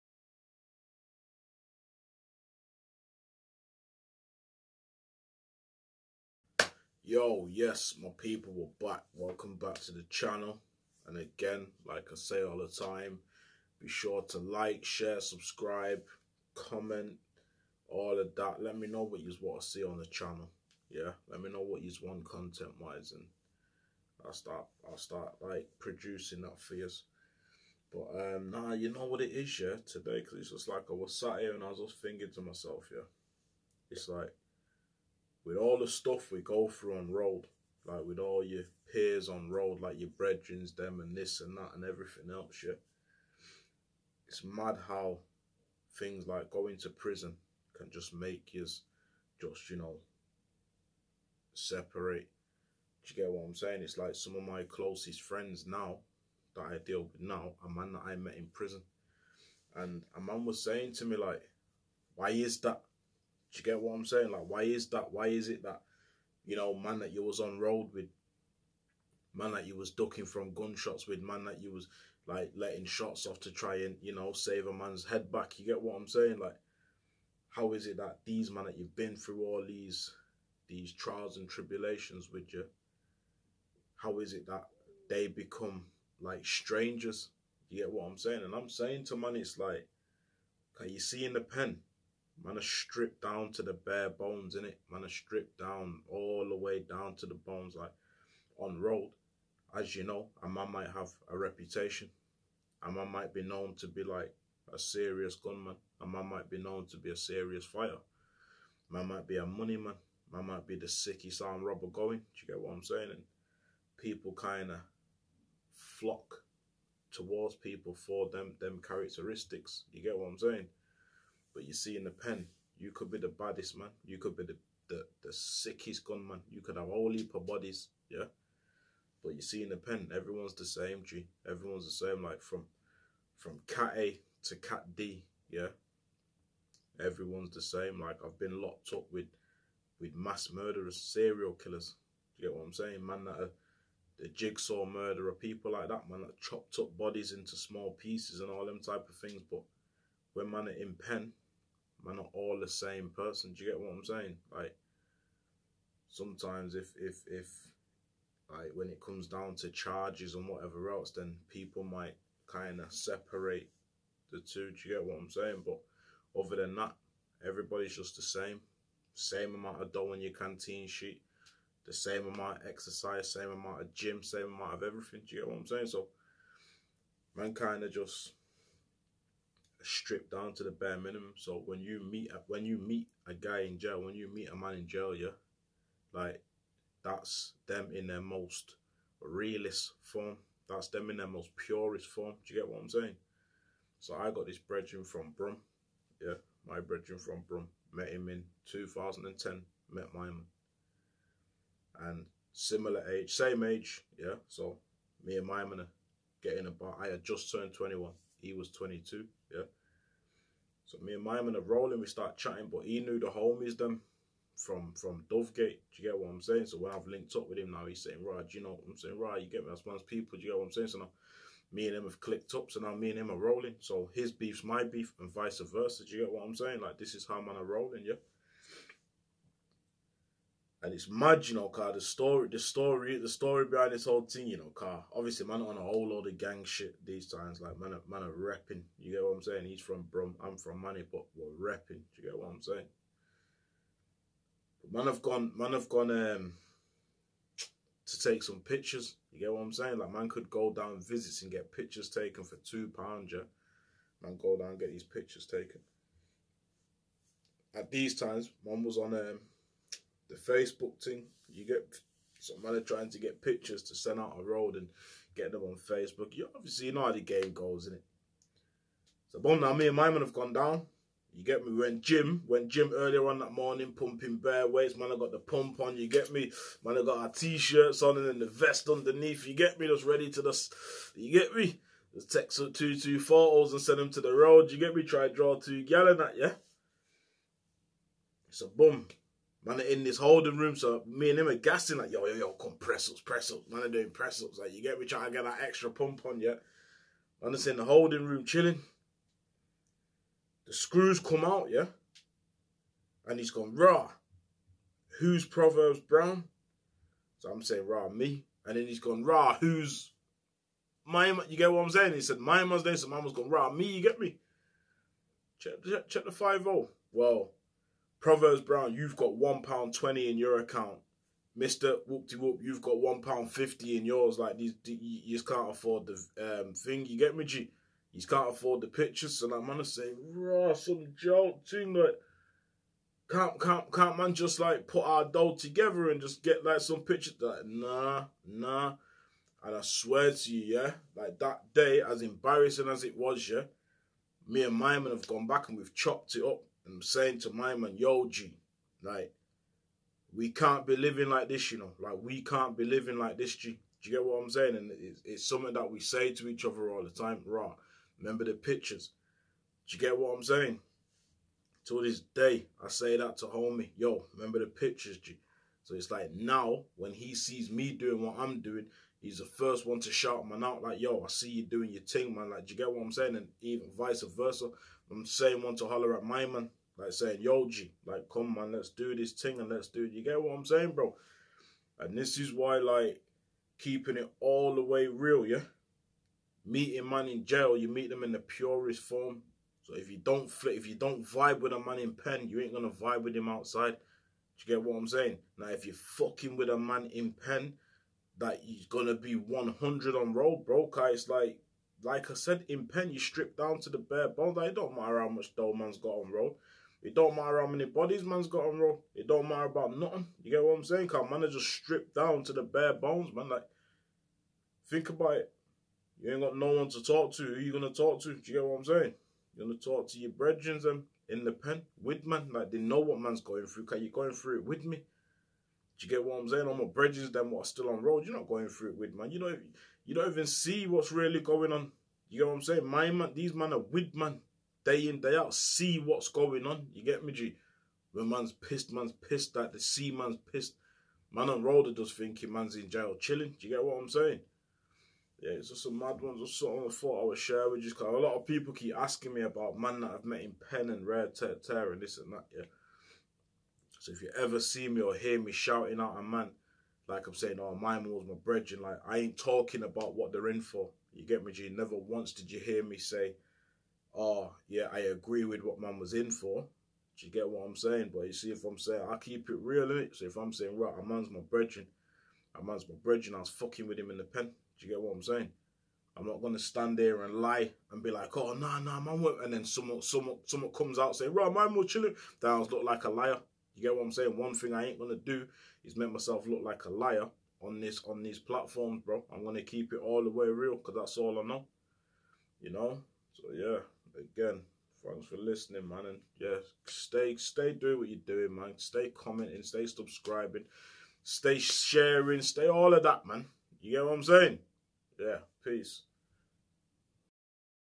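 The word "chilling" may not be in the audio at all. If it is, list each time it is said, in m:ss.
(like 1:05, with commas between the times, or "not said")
4:58, 7:23, 8:01.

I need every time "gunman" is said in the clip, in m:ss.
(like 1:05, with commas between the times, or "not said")
1:45, 2:06.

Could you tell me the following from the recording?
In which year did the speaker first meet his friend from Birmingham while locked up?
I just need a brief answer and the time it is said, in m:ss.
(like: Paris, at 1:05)
2010, at 3:18.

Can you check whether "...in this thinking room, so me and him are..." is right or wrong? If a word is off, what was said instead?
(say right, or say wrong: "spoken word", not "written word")
wrong: "holding", not "thinking".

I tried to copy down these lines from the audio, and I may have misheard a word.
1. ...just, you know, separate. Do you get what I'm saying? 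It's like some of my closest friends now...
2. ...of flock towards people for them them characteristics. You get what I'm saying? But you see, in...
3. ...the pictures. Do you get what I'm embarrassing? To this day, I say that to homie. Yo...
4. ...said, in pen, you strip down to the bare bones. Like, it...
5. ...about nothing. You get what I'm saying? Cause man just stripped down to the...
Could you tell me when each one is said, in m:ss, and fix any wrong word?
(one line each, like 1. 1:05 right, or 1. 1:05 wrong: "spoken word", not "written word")
1. 0:48 right
2. 1:54 right
3. 5:58 wrong: "saying", not "embarrassing"
4. 6:42 right
5. 6:49 right.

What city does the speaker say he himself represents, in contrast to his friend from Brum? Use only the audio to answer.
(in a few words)
Manny.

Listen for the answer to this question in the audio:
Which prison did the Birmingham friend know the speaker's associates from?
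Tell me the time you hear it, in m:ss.
3:35.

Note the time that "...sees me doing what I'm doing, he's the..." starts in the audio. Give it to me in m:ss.
6:07.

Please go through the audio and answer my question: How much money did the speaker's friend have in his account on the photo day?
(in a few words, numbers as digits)
£1.50.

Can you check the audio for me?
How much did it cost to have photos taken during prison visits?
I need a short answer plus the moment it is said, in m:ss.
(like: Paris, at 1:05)
£2, at 4:12.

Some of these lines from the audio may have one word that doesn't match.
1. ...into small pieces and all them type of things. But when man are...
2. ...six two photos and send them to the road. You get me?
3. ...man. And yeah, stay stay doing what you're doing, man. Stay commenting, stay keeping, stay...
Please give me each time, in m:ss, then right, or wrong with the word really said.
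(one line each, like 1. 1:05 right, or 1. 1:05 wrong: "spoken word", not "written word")
1. 2:27 right
2. 4:42 wrong: "two", not "six"
3. 8:15 wrong: "subscribing", not "keeping".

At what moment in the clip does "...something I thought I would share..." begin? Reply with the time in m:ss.
7:26.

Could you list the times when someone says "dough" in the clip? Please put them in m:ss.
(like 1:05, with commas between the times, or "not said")
2:49, 5:35, 6:45.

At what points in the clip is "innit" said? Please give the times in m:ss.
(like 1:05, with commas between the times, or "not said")
4:27, 7:49.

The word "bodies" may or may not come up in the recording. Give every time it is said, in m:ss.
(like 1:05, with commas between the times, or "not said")
2:07, 2:26, 6:47.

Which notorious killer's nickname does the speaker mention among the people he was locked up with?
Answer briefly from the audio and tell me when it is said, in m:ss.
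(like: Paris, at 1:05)
the jigsaw murderer, at 2:24.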